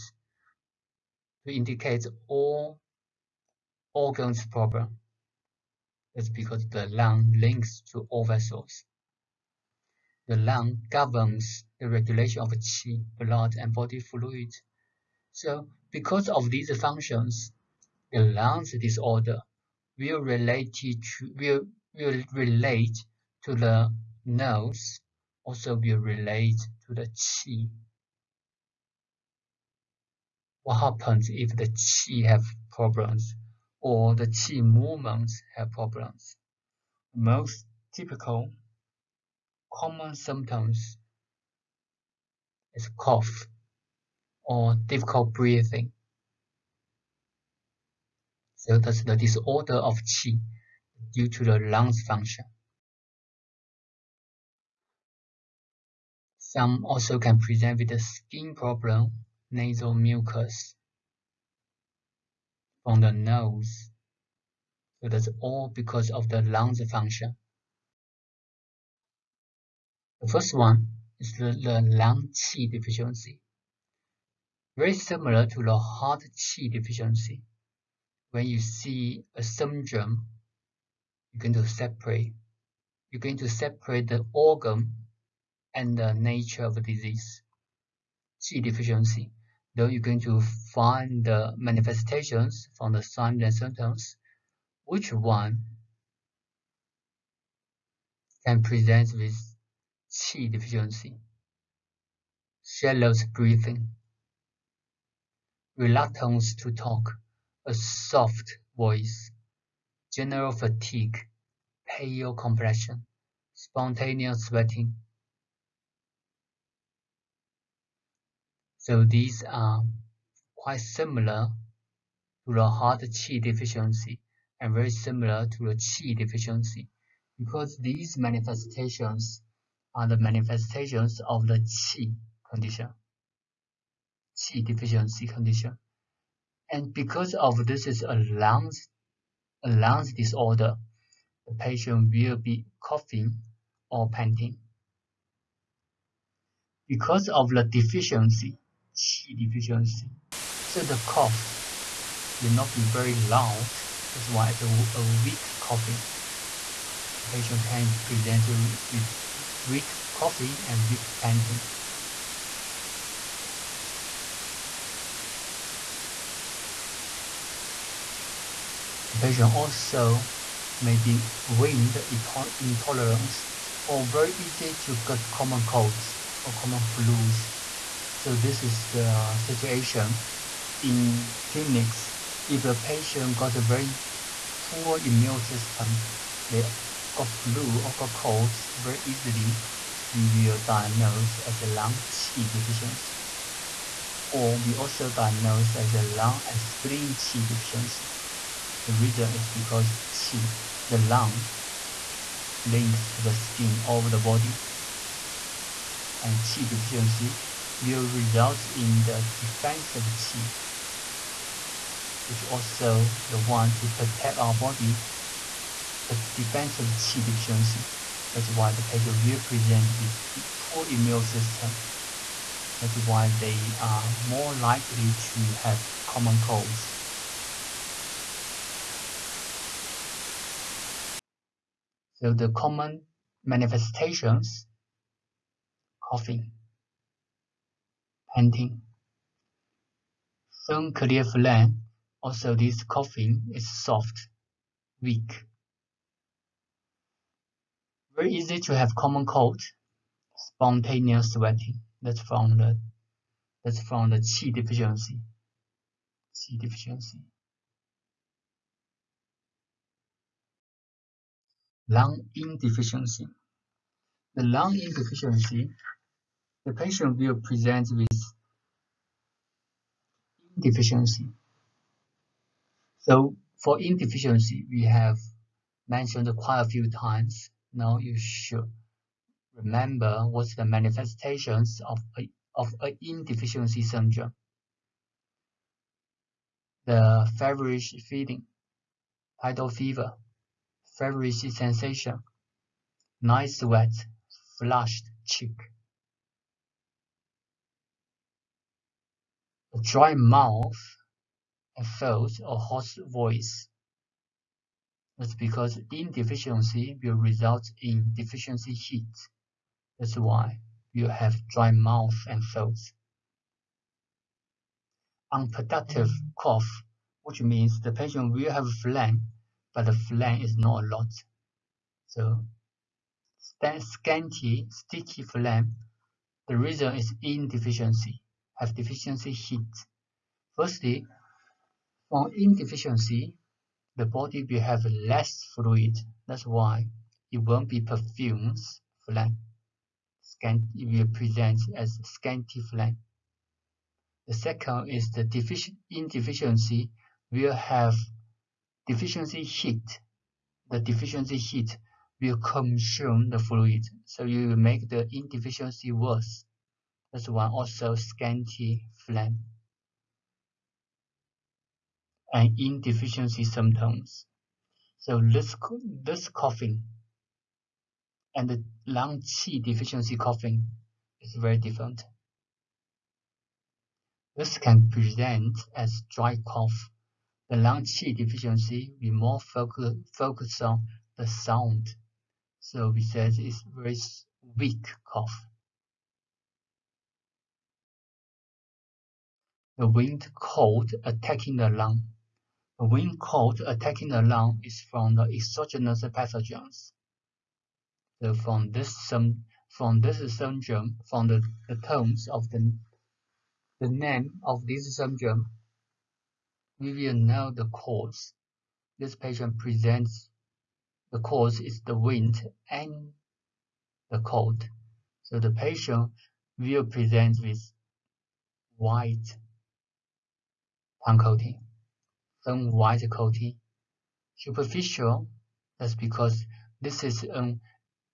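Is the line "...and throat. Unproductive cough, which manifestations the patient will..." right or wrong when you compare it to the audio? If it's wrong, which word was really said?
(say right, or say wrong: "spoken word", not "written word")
wrong: "means", not "manifestations".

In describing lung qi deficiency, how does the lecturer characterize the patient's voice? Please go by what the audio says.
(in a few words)
Soft voice.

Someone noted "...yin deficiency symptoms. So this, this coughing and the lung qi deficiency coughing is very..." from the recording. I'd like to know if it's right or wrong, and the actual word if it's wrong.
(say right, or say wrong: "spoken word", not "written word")
right.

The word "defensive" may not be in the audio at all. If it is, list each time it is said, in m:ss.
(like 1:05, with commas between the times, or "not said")
3:29, 3:36.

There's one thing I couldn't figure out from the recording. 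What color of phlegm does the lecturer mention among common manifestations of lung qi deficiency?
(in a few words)
Clear.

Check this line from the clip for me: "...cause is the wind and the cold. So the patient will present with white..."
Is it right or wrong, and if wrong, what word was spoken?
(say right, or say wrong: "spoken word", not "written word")
right.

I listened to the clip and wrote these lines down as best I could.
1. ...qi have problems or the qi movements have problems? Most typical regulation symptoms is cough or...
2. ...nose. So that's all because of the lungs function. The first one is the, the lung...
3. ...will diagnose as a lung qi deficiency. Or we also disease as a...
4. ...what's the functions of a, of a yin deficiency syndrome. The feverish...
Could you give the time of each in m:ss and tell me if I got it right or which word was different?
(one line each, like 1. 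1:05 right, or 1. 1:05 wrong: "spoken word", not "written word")
1. 0:31 wrong: "common", not "regulation"
2. 1:03 right
3. 3:10 wrong: "diagnose", not "disease"
4. 4:40 wrong: "manifestations", not "functions".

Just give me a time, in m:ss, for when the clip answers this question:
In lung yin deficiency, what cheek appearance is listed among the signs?
4:54.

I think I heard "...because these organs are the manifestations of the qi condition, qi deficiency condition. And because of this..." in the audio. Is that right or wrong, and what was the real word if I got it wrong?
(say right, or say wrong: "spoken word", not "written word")
wrong: "manifestations", not "organs".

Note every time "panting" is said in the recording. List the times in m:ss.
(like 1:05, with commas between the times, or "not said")
2:24, 2:41, 3:58.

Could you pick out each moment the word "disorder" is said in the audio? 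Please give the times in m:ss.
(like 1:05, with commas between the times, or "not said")
0:18, 0:49, 2:20.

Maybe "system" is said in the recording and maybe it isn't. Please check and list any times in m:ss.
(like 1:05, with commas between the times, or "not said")
3:05, 3:41.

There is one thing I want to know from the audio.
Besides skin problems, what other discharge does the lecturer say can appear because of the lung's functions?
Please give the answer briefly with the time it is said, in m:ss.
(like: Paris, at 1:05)
Nasal mucus, at 0:59.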